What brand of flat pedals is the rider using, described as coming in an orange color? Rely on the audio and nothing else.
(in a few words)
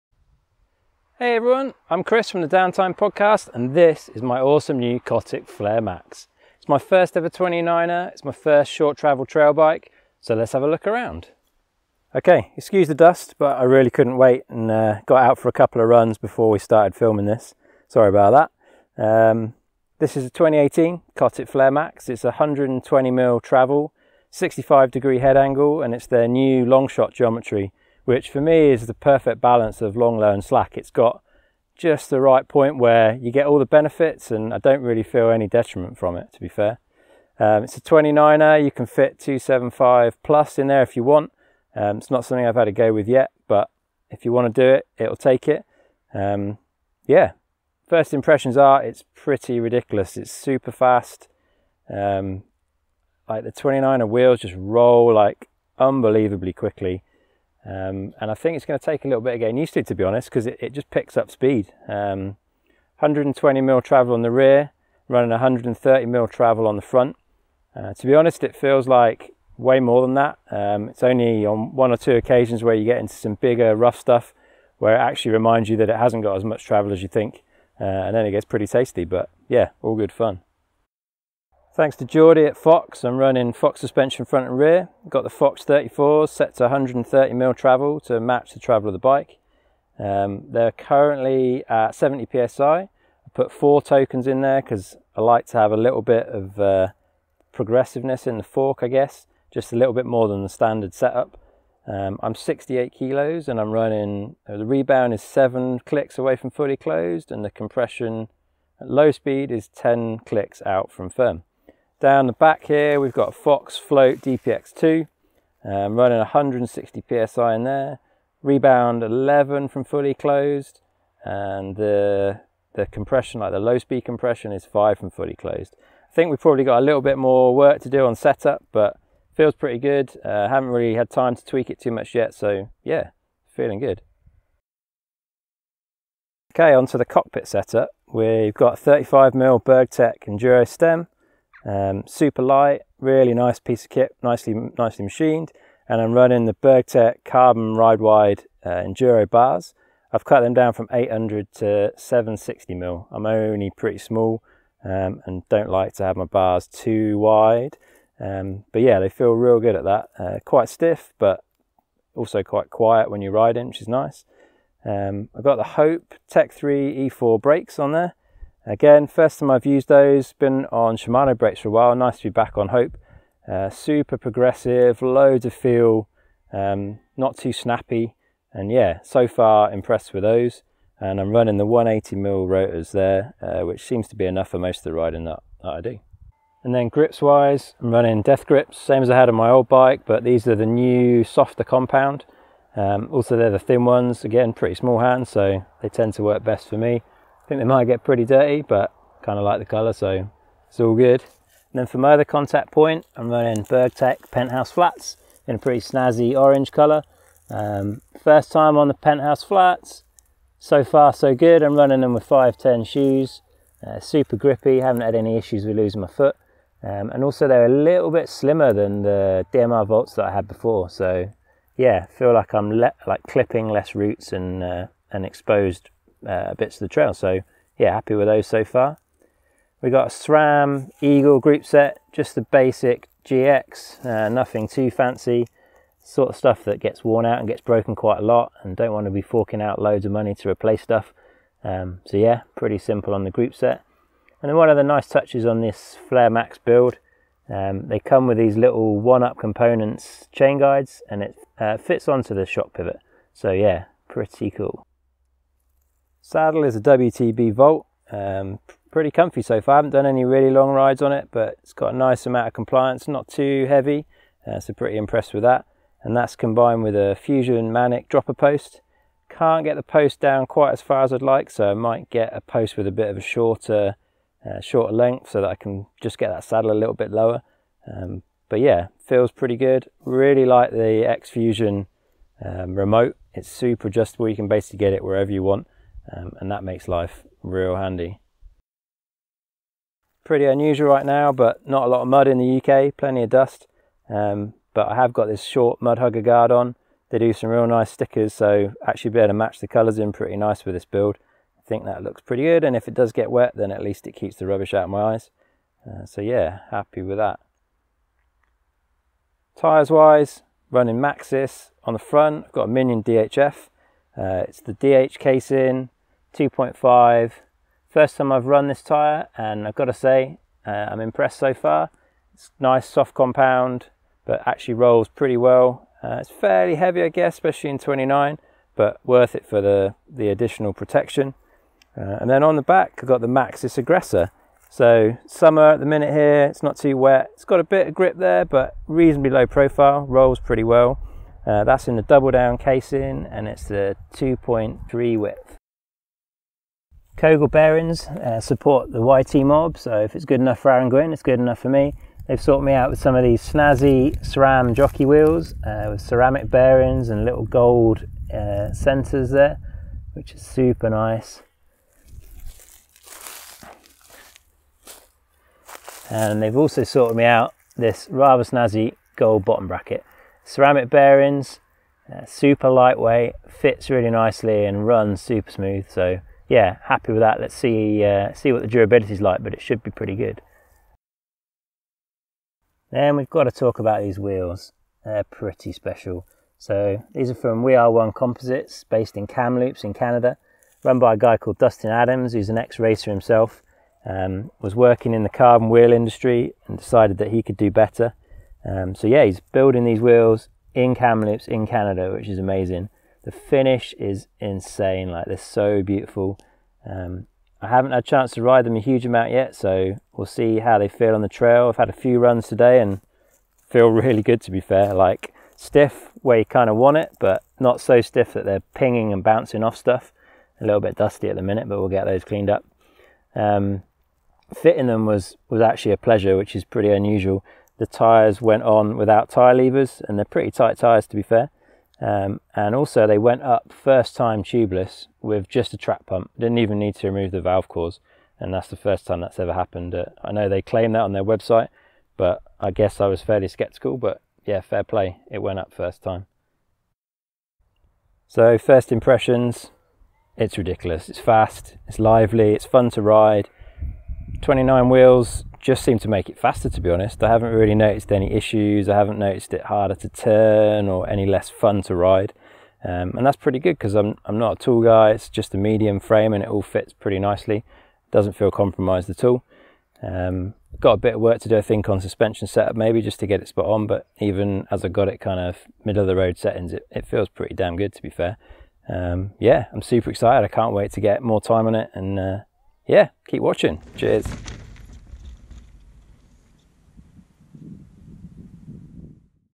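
Burgtec Penthouse Flats.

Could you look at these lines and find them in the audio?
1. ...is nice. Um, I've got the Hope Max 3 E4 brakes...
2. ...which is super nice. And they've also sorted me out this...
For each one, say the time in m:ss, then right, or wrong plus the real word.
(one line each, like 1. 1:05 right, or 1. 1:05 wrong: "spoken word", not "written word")
1. 2:43 wrong: "Tech", not "Max"
2. 6:00 right.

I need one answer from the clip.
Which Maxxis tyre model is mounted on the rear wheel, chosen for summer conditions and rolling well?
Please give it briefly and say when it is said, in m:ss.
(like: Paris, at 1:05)
Aggressor, at 5:33.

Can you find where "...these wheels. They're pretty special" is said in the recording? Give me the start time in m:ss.
6:24.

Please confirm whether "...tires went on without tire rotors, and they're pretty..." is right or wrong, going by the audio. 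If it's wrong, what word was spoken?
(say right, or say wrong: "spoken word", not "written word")
wrong: "levers", not "rotors".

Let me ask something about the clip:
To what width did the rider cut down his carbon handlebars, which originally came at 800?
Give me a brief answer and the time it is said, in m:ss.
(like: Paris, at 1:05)
760 mil, at 2:31.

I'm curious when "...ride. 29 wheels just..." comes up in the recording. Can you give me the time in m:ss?
7:33.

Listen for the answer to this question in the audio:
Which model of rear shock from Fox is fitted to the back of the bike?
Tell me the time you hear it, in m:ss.
1:53.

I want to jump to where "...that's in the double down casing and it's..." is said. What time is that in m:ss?
5:41.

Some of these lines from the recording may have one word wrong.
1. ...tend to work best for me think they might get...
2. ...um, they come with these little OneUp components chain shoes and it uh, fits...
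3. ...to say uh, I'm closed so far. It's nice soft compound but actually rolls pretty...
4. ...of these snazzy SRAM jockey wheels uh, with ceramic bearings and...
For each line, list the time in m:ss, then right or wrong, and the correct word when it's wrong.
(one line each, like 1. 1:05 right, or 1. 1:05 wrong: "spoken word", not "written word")
1. 3:15 right
2. 4:07 wrong: "guides", not "shoes"
3. 5:19 wrong: "impressed", not "closed"
4. 5:53 right.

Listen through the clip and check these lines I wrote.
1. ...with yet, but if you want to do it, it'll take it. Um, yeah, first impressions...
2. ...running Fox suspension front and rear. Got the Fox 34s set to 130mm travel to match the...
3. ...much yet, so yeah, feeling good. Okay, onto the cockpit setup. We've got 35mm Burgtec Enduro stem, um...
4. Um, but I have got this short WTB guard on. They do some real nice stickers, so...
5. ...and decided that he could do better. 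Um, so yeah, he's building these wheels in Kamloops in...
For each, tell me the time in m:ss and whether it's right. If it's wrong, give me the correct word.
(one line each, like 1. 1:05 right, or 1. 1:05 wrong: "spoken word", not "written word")
1. 0:42 right
2. 1:23 right
3. 2:11 right
4. 4:54 wrong: "Mudhugger", not "WTB"
5. 6:36 right.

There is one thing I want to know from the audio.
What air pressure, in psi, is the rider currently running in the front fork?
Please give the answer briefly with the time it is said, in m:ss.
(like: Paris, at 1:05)
70 psi, at 1:31.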